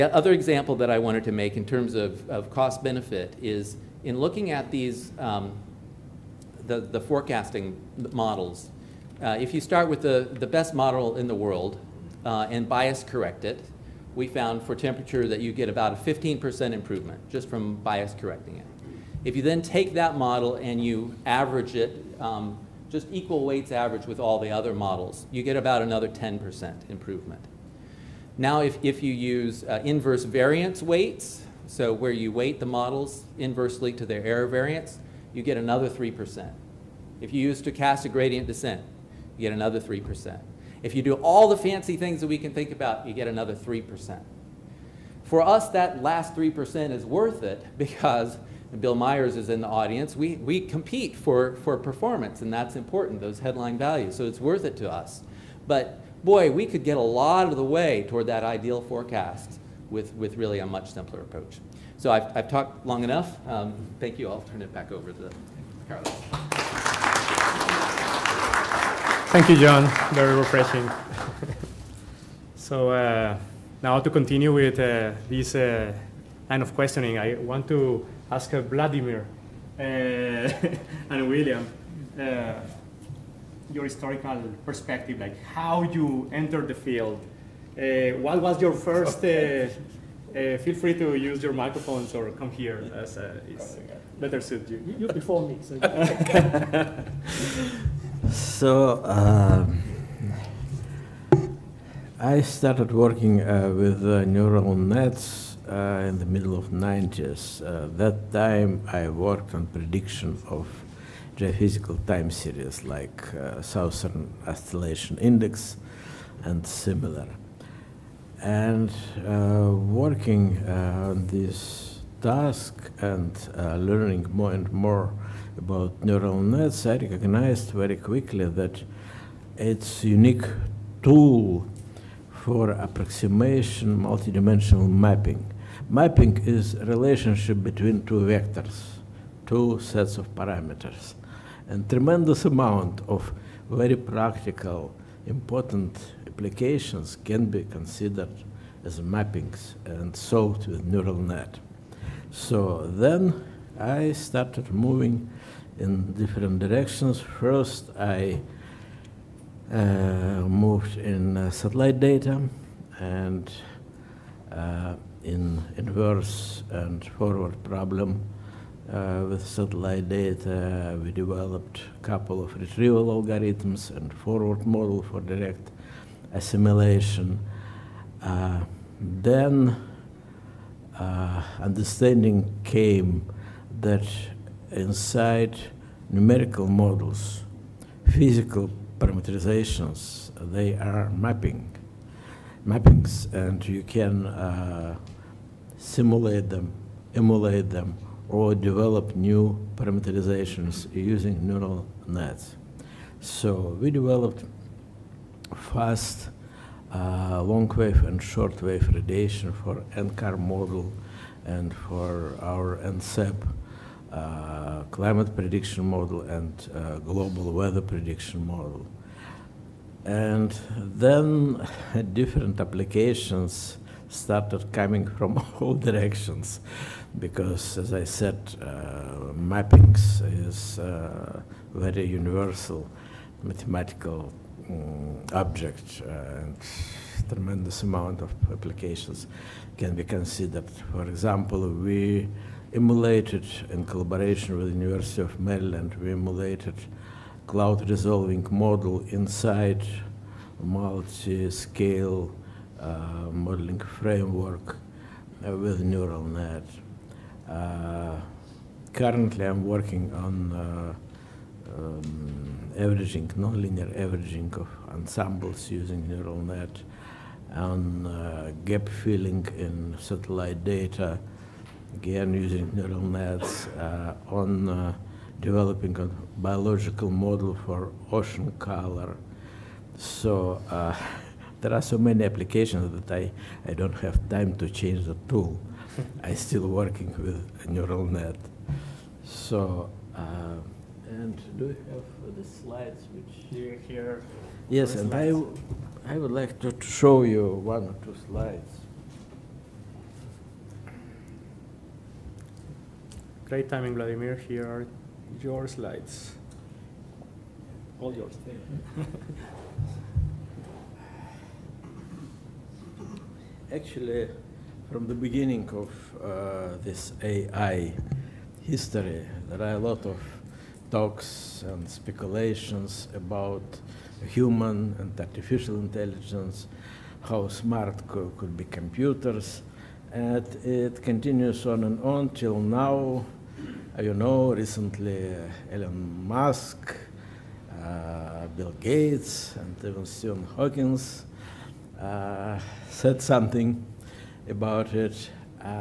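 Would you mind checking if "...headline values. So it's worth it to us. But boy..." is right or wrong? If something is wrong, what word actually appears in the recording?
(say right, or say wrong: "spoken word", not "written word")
right.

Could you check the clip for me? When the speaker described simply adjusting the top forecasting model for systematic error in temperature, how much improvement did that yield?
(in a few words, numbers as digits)
15%.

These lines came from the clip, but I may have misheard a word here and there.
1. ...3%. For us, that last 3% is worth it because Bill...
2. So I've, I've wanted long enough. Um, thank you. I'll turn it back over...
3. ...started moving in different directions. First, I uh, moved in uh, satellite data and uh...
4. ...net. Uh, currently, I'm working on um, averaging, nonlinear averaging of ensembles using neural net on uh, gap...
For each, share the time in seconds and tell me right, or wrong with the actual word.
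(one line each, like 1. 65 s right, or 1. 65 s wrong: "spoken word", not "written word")
1. 43 s right
2. 61 s wrong: "talked", not "wanted"
3. 154 s right
4. 256 s right.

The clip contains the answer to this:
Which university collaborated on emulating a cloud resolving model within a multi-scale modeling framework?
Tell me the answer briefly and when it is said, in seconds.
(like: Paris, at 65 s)
University of Maryland, at 244 s.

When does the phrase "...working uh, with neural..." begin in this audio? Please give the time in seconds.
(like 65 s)
102 s.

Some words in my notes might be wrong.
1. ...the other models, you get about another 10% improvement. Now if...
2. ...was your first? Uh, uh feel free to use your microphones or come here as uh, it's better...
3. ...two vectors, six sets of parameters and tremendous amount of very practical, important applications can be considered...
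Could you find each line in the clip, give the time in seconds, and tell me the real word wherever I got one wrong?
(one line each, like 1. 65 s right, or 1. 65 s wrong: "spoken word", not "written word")
1. 24 s right
2. 88 s right
3. 138 s wrong: "two", not "six".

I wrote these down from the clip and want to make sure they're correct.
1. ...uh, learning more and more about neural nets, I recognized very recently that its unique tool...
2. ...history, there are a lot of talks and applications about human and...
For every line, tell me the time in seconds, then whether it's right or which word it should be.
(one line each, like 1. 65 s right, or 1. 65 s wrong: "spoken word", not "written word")
1. 123 s wrong: "quickly", not "recently"
2. 318 s wrong: "speculations", not "applications".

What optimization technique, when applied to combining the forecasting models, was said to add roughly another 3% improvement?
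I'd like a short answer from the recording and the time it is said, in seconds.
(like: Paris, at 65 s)
stochastic gradient descent, at 37 s.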